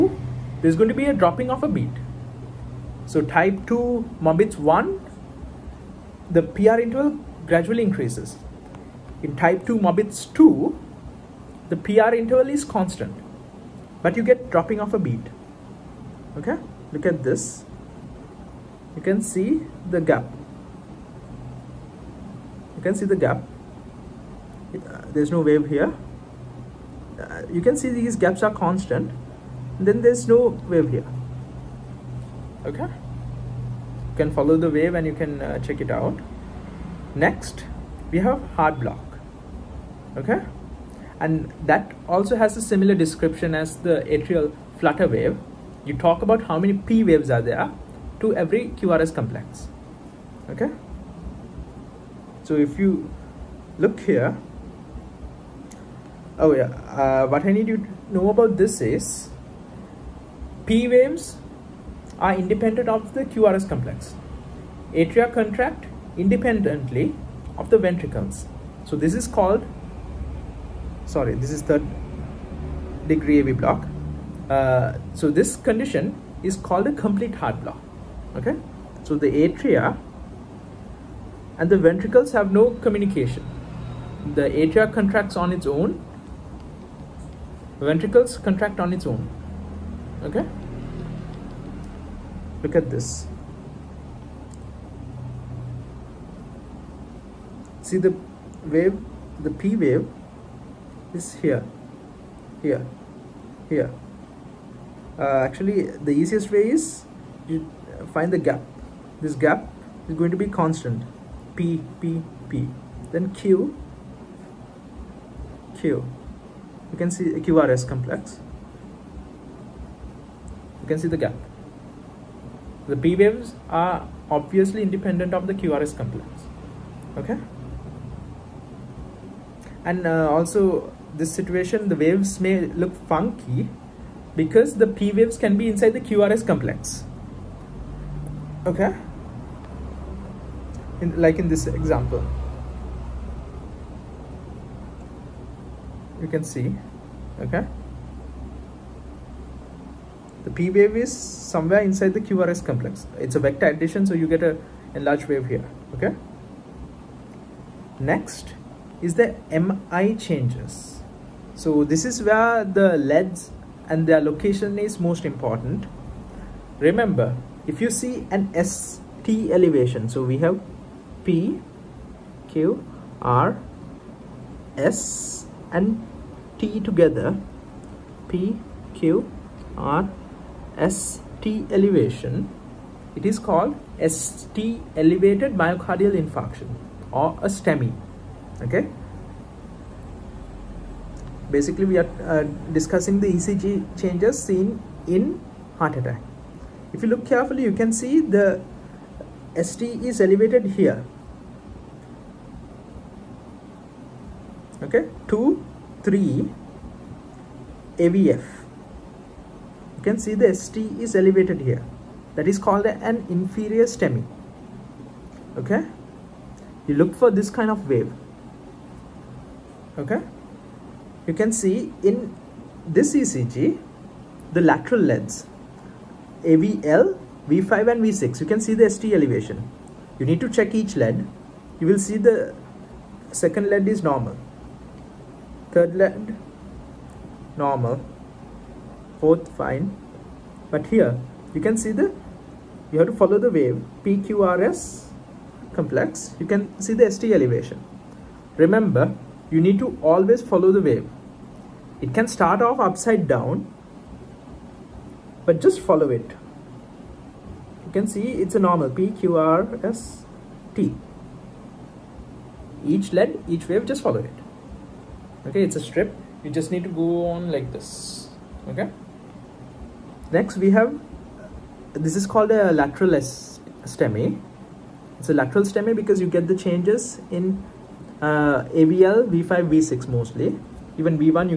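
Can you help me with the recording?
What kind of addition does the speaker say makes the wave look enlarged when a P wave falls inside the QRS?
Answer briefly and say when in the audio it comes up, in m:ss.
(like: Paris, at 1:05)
vector addition, at 2:33.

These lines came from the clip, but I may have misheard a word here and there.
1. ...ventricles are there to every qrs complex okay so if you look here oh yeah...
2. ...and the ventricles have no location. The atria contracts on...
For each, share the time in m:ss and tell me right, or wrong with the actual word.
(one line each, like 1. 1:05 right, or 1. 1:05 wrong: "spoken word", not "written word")
1. 0:47 wrong: "waves", not "ventricles"
2. 1:21 wrong: "communication", not "location".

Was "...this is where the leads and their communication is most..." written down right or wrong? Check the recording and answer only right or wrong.
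wrong.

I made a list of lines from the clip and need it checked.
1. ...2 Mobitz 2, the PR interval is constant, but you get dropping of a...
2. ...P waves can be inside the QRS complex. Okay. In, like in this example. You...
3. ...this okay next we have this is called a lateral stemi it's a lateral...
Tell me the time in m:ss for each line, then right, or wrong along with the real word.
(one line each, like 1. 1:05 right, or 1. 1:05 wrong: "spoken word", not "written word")
1. 0:09 right
2. 2:14 right
3. 4:27 right.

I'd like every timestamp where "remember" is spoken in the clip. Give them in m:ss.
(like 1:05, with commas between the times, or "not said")
2:46, 4:08.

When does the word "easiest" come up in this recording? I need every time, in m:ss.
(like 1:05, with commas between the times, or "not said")
1:46.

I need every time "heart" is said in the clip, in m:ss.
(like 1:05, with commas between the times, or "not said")
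0:38, 1:17, 3:15.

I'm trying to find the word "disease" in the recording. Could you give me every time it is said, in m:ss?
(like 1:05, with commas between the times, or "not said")
not said.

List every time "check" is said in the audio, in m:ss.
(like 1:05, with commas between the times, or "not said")
0:35, 3:50.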